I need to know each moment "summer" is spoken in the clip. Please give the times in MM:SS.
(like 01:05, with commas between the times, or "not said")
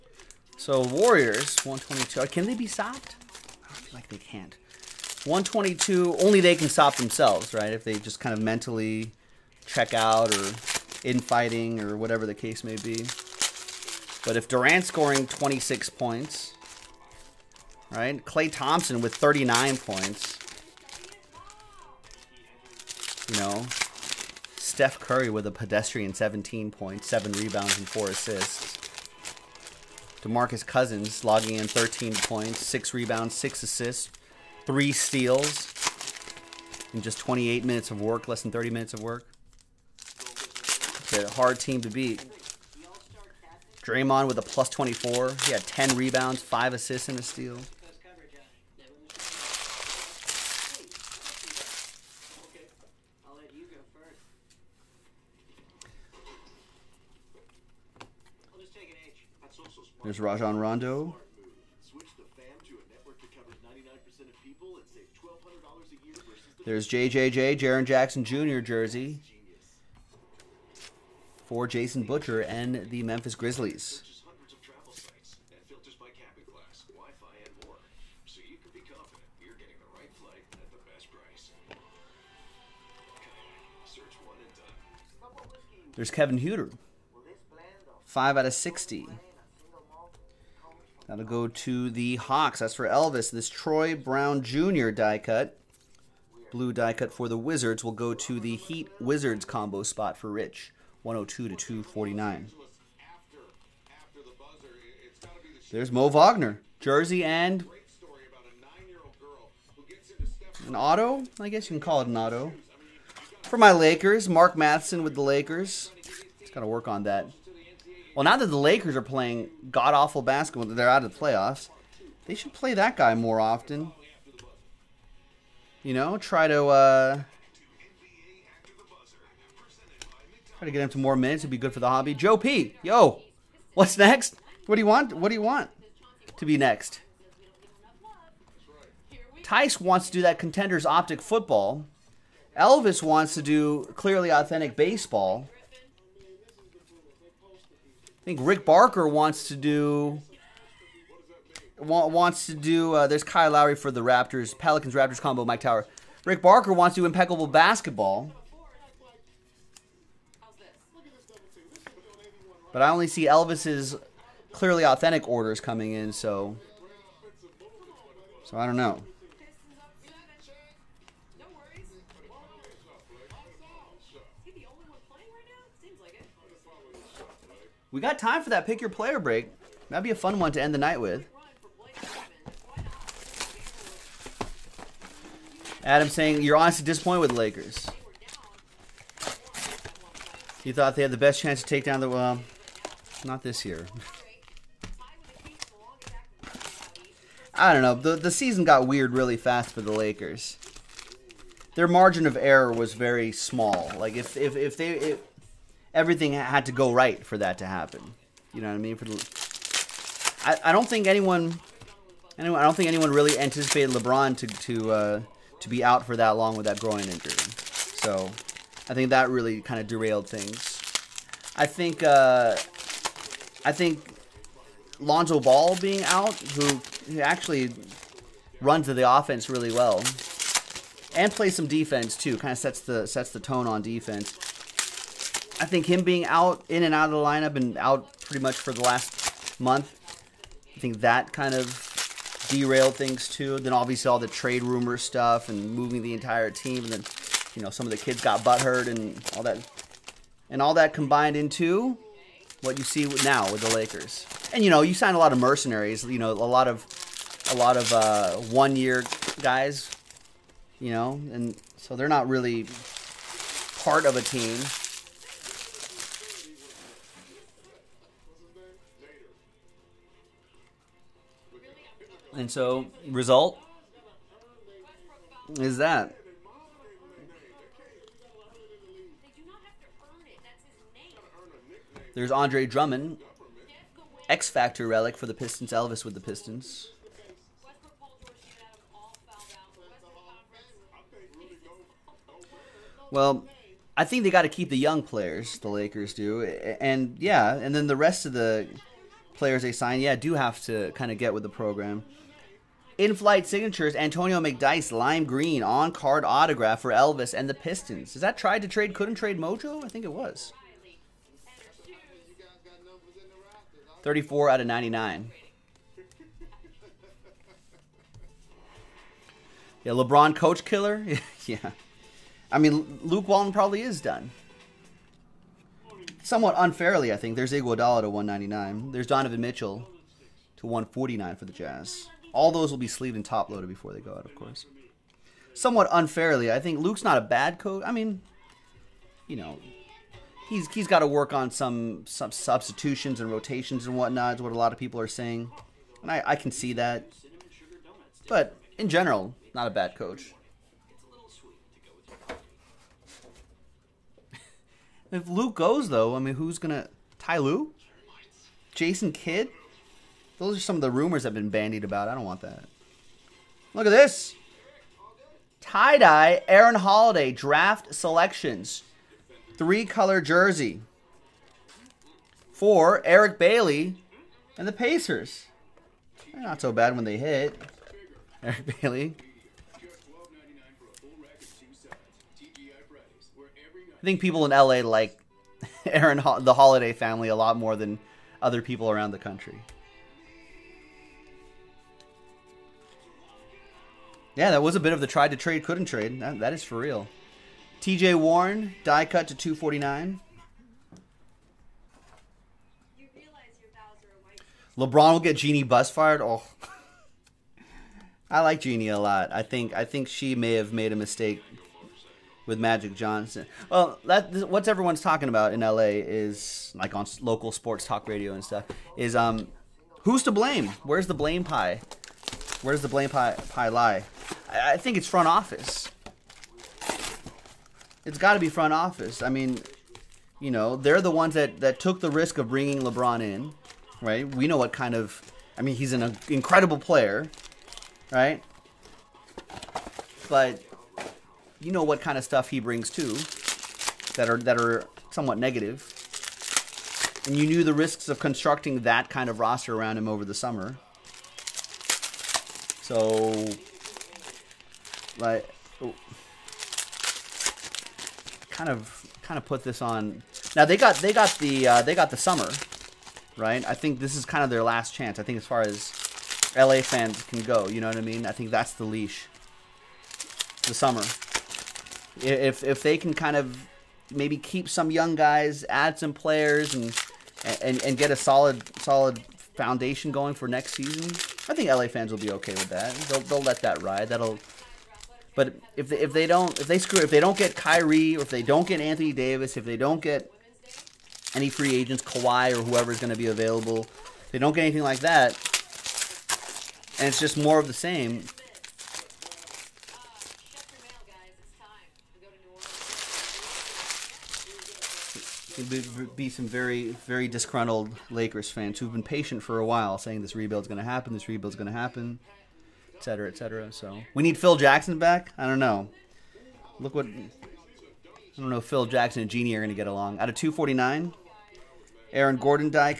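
07:30, 07:42, 07:50.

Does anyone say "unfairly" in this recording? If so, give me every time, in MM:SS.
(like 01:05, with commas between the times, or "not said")
05:26, 05:35.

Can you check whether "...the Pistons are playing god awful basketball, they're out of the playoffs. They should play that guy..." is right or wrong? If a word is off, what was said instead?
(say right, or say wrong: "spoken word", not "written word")
wrong: "Lakers", not "Pistons".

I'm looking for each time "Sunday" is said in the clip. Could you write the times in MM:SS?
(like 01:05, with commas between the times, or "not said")
not said.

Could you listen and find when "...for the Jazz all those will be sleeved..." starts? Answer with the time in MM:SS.
05:31.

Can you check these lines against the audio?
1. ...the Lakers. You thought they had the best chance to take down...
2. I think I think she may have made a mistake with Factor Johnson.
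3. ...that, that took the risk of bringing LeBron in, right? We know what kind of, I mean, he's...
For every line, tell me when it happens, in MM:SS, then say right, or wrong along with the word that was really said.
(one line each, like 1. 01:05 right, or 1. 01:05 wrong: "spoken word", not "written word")
1. 03:07 right
2. 06:49 wrong: "Magic", not "Factor"
3. 07:11 right.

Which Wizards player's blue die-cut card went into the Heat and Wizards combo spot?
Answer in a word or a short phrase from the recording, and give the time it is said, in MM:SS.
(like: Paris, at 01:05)
Troy Brown Jr., at 01:33.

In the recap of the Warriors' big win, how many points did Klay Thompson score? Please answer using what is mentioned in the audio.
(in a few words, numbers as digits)
39.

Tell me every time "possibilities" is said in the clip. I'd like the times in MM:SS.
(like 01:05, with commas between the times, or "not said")
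not said.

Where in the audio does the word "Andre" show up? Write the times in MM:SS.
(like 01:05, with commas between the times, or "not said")
04:42.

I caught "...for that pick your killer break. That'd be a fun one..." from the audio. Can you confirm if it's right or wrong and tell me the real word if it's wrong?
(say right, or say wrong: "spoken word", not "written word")
wrong: "player", not "killer".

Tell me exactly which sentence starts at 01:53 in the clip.
For my Lakers, Mark Matheson with the Lakers.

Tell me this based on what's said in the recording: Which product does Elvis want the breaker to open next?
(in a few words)
Clearly Authentic baseball.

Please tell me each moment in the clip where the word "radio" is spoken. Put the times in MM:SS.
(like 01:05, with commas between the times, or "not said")
06:58.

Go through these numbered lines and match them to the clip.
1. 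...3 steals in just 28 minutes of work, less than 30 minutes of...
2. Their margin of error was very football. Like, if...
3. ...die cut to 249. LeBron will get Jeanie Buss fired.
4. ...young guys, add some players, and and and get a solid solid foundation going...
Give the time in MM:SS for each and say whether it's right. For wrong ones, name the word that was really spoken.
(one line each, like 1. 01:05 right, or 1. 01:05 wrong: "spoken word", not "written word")
1. 00:34 right
2. 03:21 wrong: "small", not "football"
3. 06:38 right
4. 07:54 right.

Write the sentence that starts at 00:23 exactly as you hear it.
You know, Steph Curry with a pedestrian 17 points, 7 rebounds, and 4 assists.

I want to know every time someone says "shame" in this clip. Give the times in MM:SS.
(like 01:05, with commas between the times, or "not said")
not said.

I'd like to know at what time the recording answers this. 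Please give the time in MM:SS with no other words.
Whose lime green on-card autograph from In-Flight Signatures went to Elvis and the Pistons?
05:03.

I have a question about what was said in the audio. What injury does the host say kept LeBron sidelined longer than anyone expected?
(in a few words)
groin injury.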